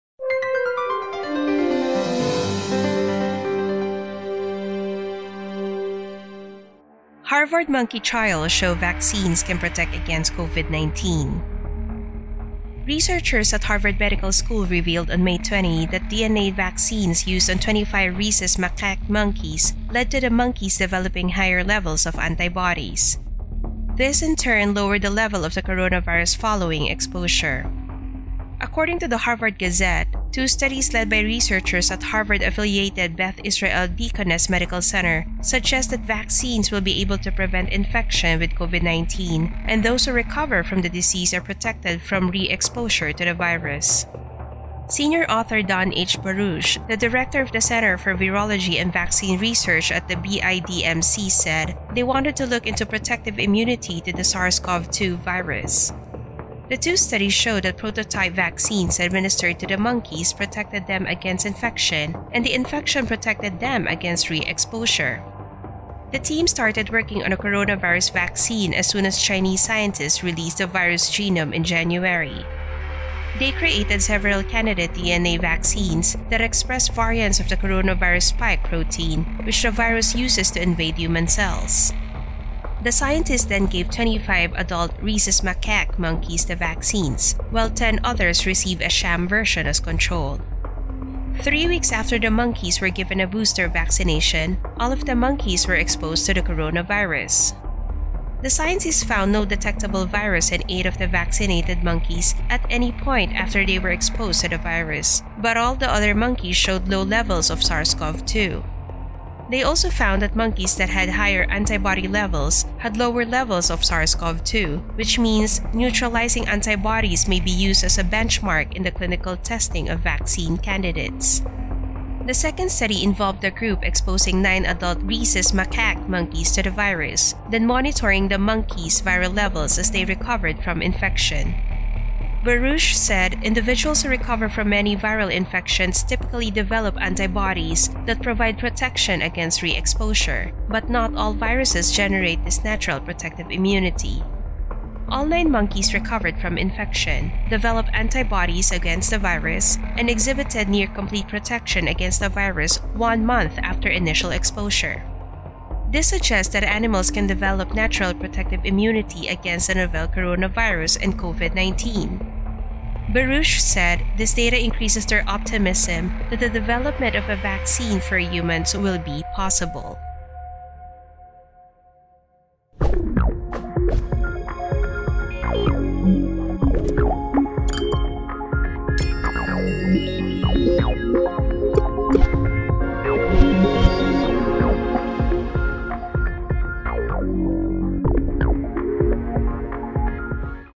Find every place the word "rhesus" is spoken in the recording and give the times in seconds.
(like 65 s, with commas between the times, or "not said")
18 s, 85 s, 125 s.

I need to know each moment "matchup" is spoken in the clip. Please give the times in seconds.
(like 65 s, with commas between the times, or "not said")
not said.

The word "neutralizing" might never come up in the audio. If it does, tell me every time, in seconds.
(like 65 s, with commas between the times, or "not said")
115 s.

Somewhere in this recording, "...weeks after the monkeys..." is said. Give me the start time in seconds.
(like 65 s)
91 s.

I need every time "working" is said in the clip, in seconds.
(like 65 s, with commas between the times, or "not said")
66 s.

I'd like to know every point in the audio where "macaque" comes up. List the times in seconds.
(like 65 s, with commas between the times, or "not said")
18 s, 85 s, 125 s.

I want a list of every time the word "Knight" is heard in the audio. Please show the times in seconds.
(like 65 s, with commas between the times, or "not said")
not said.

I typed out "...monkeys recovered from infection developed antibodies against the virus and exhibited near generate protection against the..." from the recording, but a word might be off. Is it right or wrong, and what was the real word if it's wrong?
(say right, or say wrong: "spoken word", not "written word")
wrong: "complete", not "generate".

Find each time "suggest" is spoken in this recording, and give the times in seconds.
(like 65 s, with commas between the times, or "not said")
35 s, 156 s.